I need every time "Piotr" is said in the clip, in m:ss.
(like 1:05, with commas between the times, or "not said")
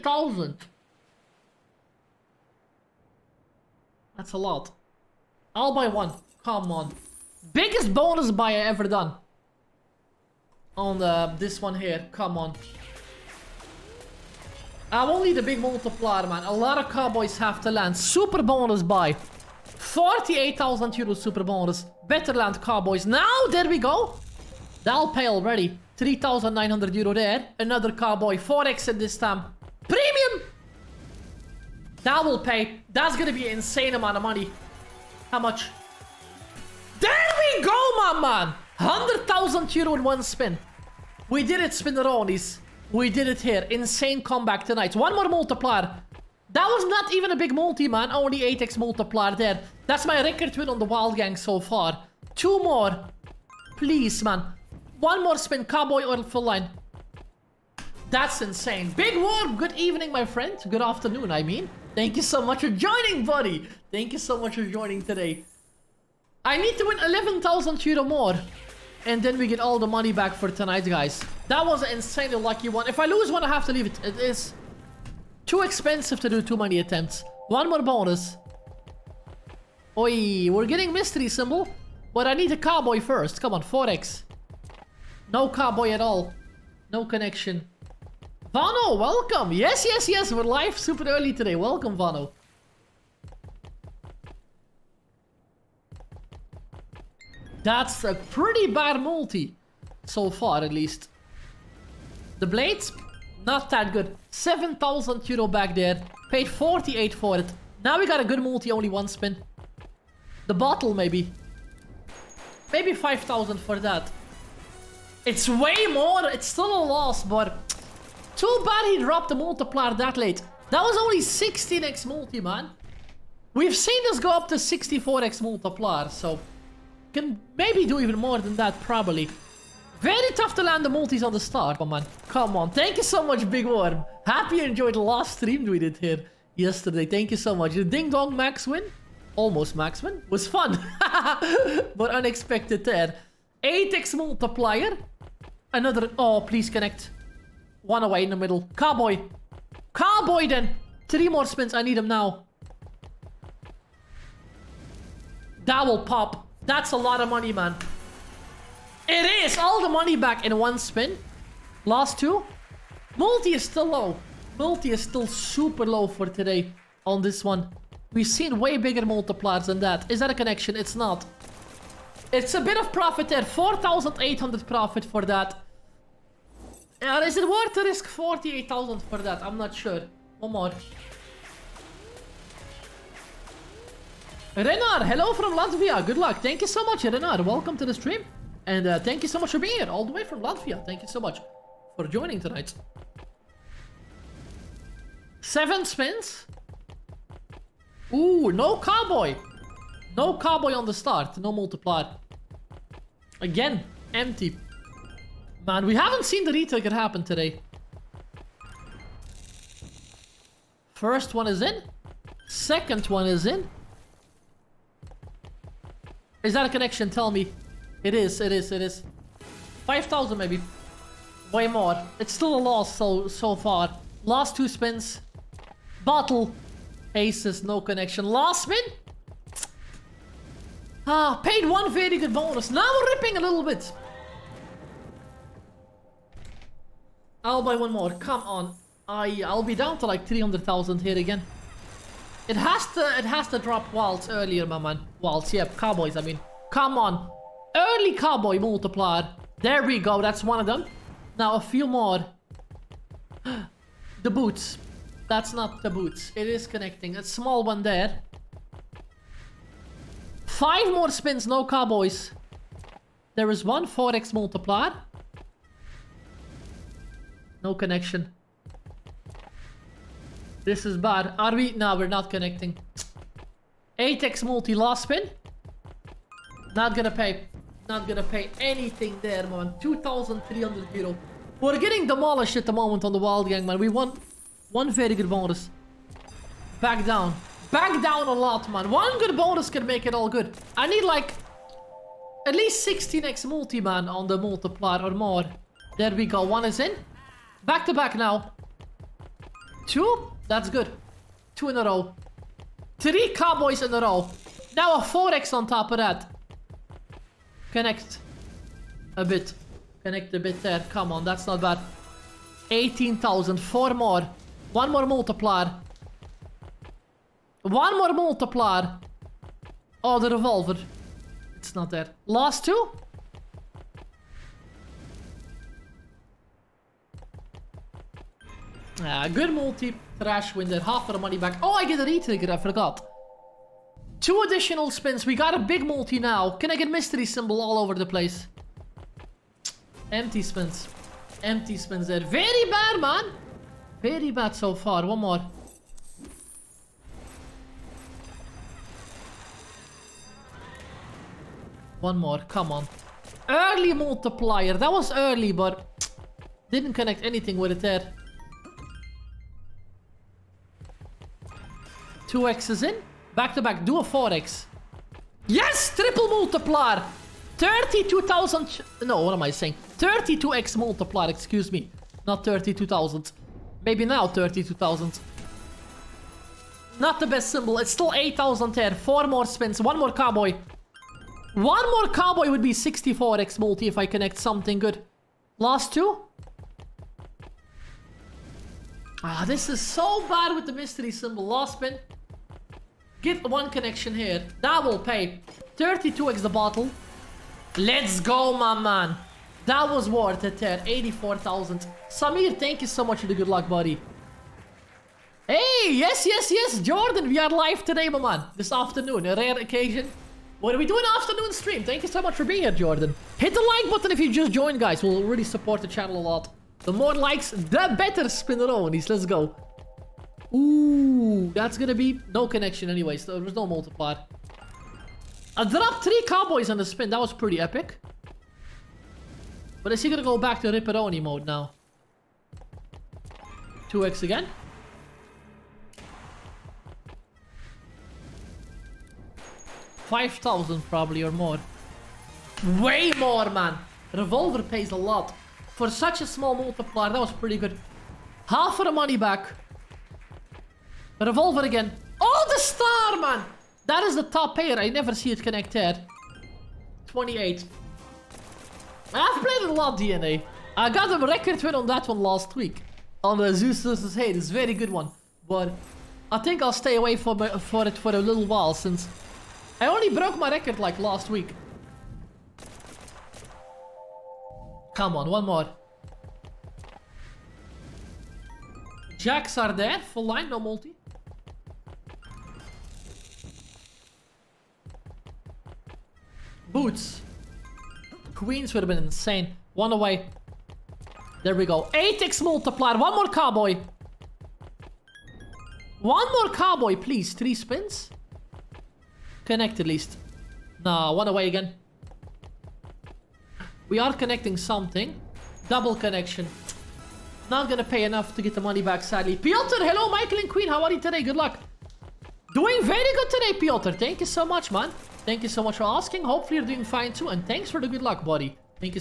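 8:29, 8:33.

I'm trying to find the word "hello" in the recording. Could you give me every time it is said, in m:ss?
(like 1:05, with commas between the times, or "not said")
3:05, 8:29.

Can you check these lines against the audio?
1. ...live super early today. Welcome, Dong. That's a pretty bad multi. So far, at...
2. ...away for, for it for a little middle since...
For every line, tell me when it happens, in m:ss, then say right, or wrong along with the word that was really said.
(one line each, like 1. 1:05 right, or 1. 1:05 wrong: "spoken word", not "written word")
1. 1:30 wrong: "Vano", not "Dong"
2. 7:46 wrong: "while", not "middle".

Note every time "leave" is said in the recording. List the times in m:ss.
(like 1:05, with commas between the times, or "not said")
1:13.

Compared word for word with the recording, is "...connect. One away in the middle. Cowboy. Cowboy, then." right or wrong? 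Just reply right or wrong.
right.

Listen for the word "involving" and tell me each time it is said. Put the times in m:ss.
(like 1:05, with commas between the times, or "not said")
not said.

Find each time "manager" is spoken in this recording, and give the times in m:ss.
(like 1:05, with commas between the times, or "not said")
not said.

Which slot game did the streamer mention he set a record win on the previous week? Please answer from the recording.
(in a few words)
Zeus versus Hades.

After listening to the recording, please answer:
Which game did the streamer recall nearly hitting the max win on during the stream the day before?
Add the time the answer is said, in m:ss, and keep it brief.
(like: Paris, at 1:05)
Ding Dong, at 2:17.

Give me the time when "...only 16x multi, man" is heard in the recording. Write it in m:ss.
2:00.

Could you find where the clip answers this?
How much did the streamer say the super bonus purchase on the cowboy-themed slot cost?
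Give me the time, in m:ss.
0:19.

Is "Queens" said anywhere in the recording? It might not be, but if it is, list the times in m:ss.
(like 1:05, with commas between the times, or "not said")
8:08, 8:30.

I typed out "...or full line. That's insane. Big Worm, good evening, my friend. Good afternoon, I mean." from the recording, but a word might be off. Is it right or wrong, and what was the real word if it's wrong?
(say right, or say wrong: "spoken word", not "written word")
right.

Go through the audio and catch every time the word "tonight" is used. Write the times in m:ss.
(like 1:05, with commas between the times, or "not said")
0:44, 1:10, 3:12.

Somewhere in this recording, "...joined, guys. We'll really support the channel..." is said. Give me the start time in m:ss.
6:54.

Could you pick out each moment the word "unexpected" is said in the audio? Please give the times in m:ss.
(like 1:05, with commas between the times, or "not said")
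2:22.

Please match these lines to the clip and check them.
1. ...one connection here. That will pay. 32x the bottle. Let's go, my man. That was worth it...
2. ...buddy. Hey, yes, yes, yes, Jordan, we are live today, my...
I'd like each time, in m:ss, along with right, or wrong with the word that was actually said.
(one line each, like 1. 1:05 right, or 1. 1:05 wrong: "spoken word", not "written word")
1. 6:33 right
2. 6:43 right.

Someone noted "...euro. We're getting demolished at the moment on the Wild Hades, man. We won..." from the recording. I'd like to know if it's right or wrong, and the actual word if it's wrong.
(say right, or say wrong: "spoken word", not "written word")
wrong: "Gang", not "Hades".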